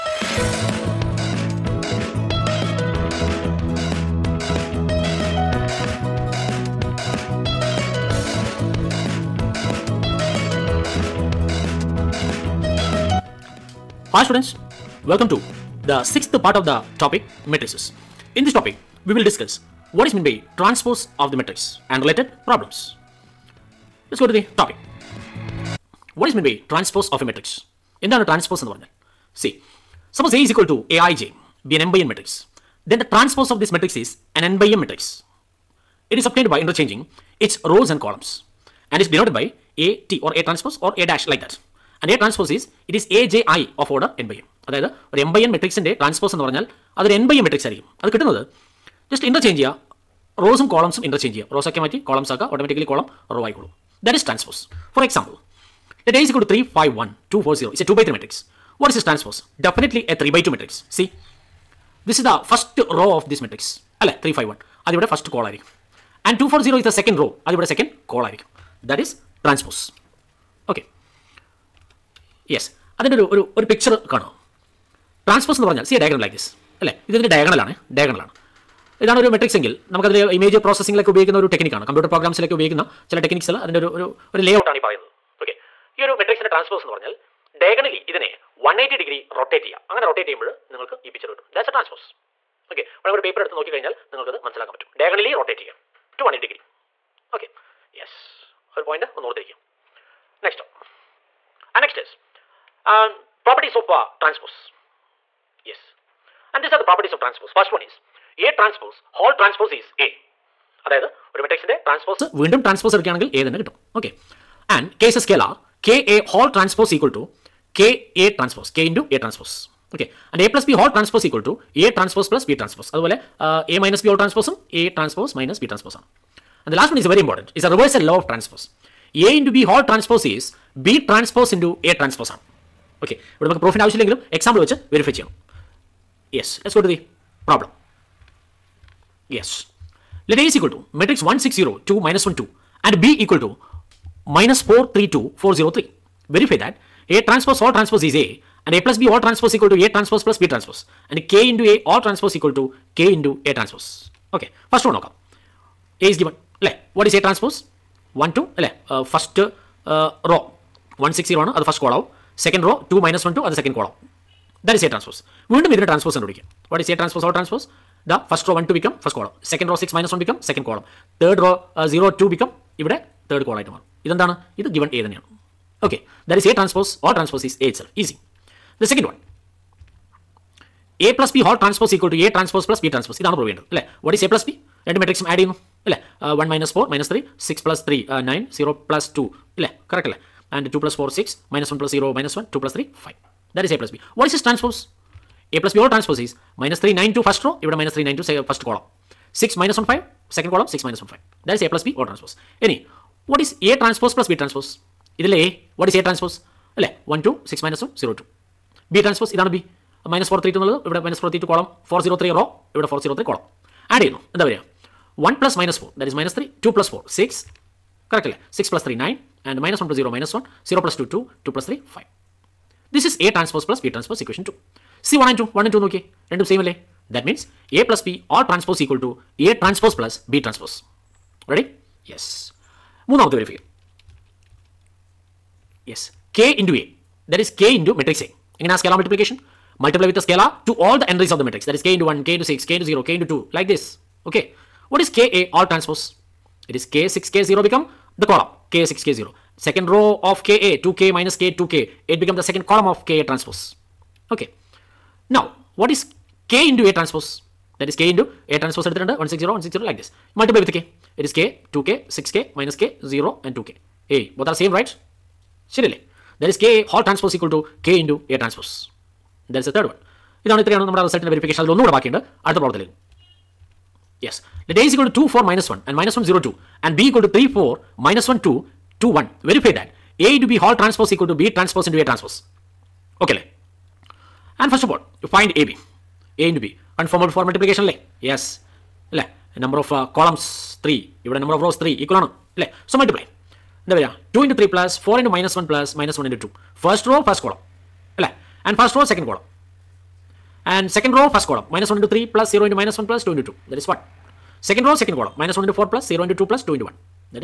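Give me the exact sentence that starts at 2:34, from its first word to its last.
Okay, first one knock A is given.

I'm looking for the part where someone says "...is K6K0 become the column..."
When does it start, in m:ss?
4:06.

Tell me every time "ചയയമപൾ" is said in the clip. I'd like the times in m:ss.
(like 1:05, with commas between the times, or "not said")
1:30.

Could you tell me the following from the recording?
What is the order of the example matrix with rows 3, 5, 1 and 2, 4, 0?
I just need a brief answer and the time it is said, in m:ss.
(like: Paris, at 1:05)
2 by 3, at 0:57.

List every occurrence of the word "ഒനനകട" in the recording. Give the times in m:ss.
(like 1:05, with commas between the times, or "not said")
4:31.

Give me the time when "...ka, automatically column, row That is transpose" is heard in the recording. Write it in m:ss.
0:52.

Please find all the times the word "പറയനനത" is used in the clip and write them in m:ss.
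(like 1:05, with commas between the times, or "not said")
1:24.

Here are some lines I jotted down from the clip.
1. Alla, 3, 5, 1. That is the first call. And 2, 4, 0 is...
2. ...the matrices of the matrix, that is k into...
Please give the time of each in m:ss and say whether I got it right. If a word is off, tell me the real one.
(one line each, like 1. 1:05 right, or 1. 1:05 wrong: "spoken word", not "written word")
1. 1:04 right
2. 4:01 wrong: "entries", not "matrices".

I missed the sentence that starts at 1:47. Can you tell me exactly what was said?
First one is A transpose, Hall transpose is A.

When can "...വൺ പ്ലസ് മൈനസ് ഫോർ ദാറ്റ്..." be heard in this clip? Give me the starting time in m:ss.
3:35.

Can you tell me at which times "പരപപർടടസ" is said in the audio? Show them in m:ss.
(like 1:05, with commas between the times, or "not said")
1:43.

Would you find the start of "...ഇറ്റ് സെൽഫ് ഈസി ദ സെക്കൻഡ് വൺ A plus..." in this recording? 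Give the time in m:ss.
2:57.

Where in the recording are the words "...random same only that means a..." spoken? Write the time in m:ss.
3:46.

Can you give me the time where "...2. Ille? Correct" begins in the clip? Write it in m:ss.
3:09.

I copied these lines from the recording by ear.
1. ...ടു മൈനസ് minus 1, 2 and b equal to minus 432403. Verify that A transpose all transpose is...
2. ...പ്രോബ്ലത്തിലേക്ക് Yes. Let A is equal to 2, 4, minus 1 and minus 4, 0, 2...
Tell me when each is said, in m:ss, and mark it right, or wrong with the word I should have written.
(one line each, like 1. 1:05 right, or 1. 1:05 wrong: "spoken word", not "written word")
1. 2:21 right
2. 4:32 wrong: "1", not "4".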